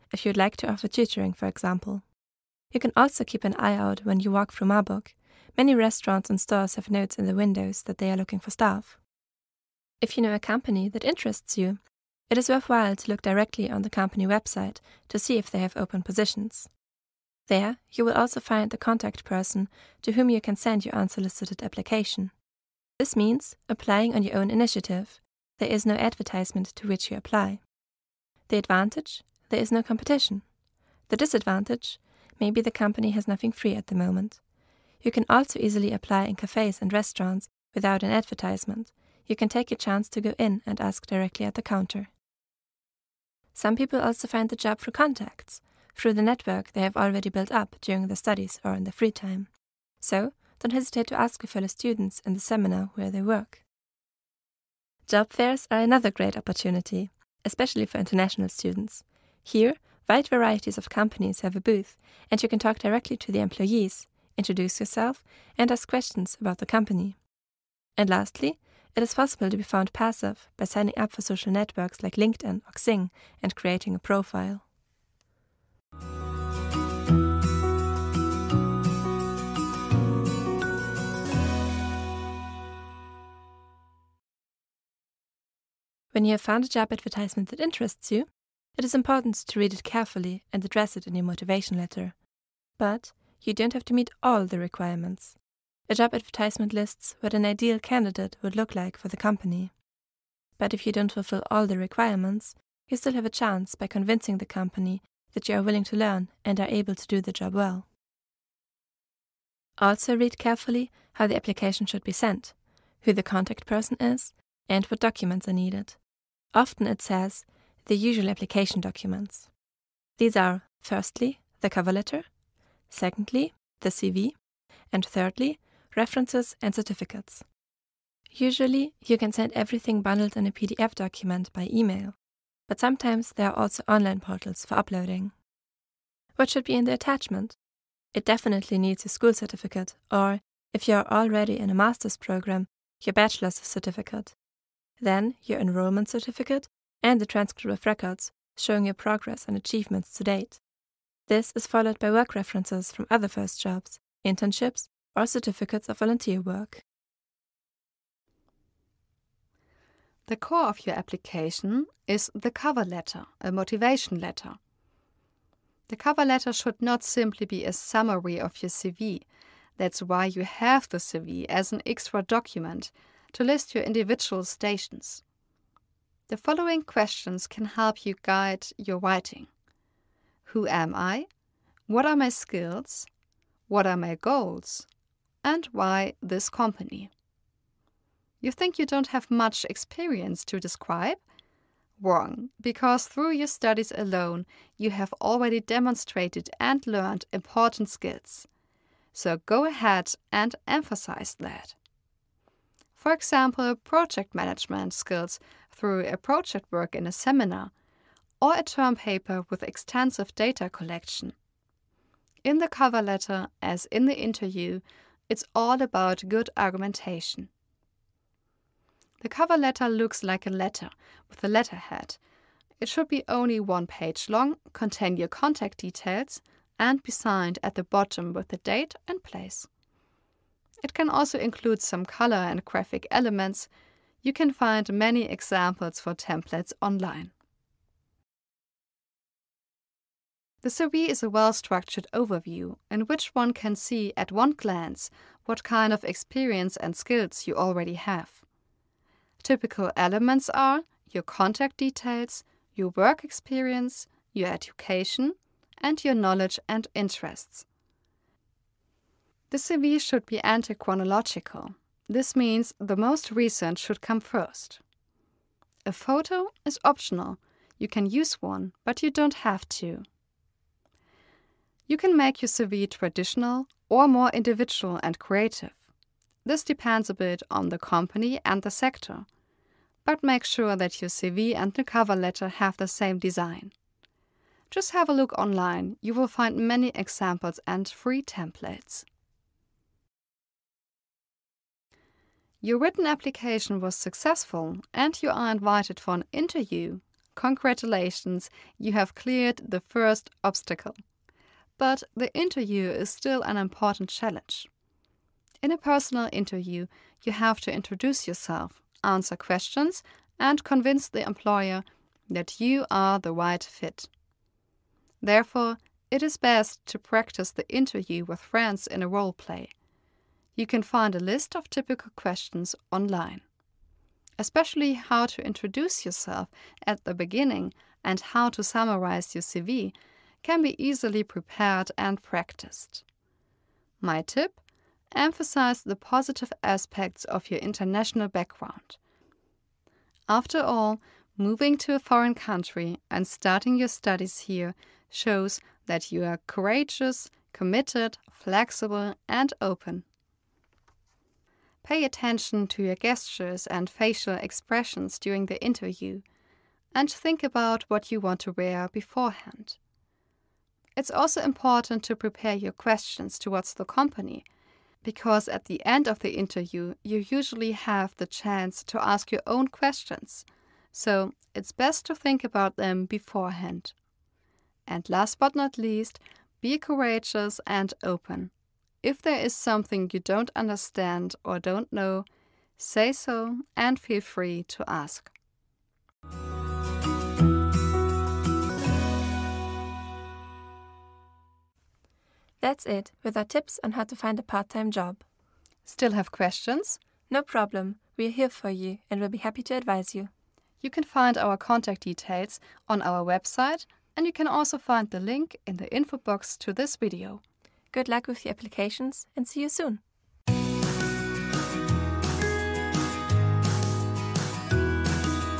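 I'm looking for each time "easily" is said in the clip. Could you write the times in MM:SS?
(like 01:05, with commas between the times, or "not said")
00:35, 05:30.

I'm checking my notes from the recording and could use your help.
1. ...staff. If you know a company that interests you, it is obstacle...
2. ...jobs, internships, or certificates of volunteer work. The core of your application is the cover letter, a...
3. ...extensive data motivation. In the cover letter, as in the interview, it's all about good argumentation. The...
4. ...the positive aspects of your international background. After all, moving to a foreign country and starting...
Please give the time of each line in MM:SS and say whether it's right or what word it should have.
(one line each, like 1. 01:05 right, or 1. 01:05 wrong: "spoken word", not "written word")
1. 00:08 wrong: "worthwhile", not "obstacle"
2. 02:33 right
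3. 03:29 wrong: "collection", not "motivation"
4. 05:35 right.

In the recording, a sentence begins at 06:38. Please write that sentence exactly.
We're here for you and we'll be happy to advise you.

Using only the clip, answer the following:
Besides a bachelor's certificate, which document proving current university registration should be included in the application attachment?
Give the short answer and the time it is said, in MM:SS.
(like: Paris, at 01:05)
Enrollment certificate, at 02:25.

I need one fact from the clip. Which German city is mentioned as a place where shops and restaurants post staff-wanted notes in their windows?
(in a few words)
Marburg.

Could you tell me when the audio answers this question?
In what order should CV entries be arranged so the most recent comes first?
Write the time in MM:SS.
04:20.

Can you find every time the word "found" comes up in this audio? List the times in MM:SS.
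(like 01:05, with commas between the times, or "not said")
01:09, 01:26.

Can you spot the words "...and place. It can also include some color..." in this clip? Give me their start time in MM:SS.
03:49.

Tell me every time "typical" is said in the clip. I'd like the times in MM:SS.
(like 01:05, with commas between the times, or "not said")
04:09, 05:21.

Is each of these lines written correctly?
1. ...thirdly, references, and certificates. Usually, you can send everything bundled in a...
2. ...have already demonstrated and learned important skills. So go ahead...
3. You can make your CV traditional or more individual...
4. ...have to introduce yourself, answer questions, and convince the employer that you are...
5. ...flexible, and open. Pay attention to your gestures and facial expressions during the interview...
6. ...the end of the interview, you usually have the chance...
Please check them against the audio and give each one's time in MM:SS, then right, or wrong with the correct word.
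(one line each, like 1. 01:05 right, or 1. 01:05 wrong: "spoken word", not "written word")
1. 02:05 right
2. 03:14 right
3. 04:31 right
4. 05:07 right
5. 05:48 right
6. 06:05 right.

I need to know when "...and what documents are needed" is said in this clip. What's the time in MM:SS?
01:54.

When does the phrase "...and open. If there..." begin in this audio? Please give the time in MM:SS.
06:17.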